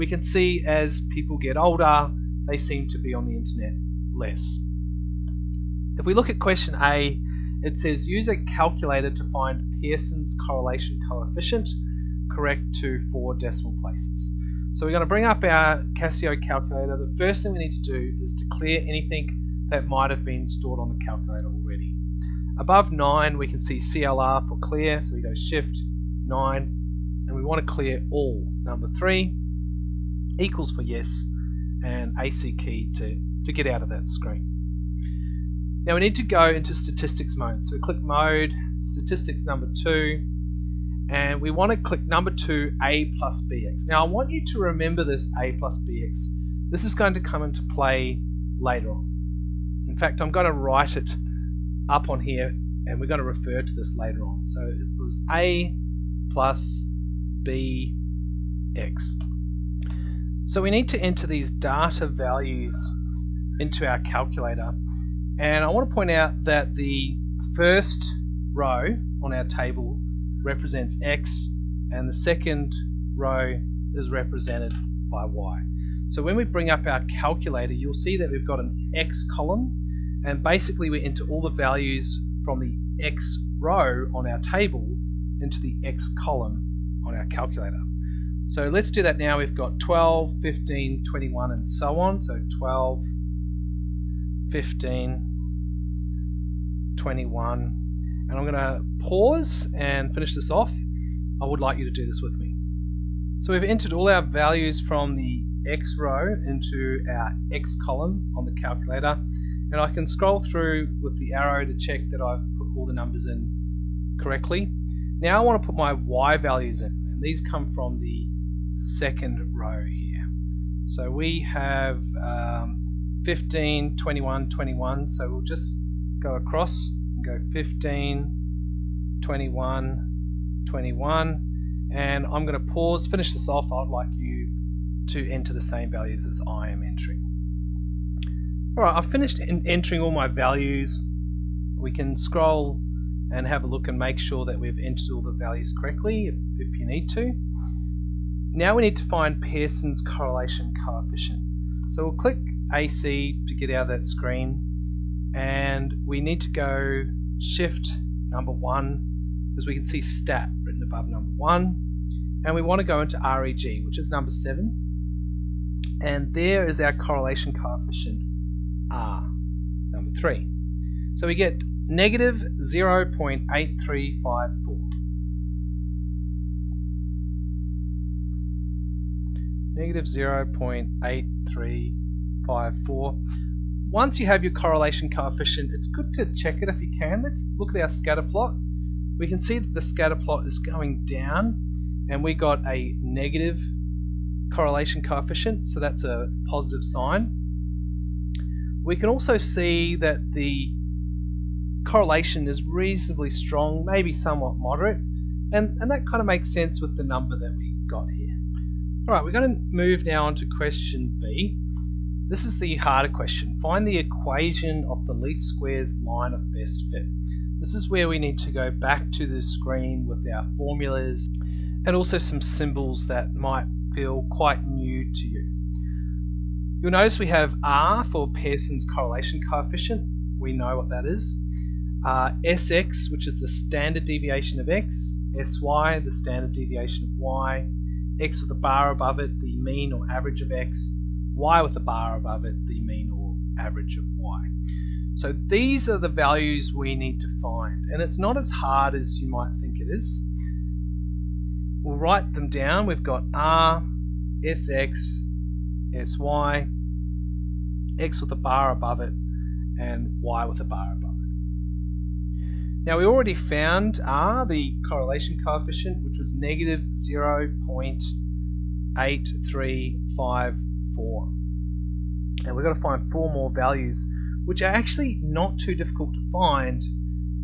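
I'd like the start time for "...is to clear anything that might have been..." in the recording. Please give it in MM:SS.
00:18.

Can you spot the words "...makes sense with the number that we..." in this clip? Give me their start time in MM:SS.
03:26.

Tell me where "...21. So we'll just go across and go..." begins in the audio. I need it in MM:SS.
02:04.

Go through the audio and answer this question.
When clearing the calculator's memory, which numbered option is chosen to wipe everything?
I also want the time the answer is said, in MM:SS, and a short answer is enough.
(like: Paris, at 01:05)
3, at 00:28.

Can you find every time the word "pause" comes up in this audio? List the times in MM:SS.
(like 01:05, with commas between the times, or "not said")
01:38, 02:12.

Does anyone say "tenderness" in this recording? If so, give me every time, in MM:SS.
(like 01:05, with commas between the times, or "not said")
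not said.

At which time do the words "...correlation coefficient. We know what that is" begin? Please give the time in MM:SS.
03:48.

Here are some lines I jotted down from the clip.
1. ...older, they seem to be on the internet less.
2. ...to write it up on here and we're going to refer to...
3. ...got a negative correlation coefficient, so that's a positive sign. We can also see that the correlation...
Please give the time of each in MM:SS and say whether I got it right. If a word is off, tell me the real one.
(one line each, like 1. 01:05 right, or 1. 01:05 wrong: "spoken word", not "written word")
1. 00:01 right
2. 00:50 right
3. 03:12 right.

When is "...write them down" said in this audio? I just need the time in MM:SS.
04:11.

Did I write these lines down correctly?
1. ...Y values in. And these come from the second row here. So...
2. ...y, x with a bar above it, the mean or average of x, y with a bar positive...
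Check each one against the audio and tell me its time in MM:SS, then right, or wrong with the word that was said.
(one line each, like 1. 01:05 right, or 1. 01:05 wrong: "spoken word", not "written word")
1. 01:55 right
2. 03:57 wrong: "above", not "positive".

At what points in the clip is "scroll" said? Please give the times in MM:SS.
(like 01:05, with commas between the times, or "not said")
01:50, 02:22.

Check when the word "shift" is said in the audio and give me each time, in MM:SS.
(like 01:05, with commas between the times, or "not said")
00:25, 02:37.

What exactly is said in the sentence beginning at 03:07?
Let's look at our scatter plot.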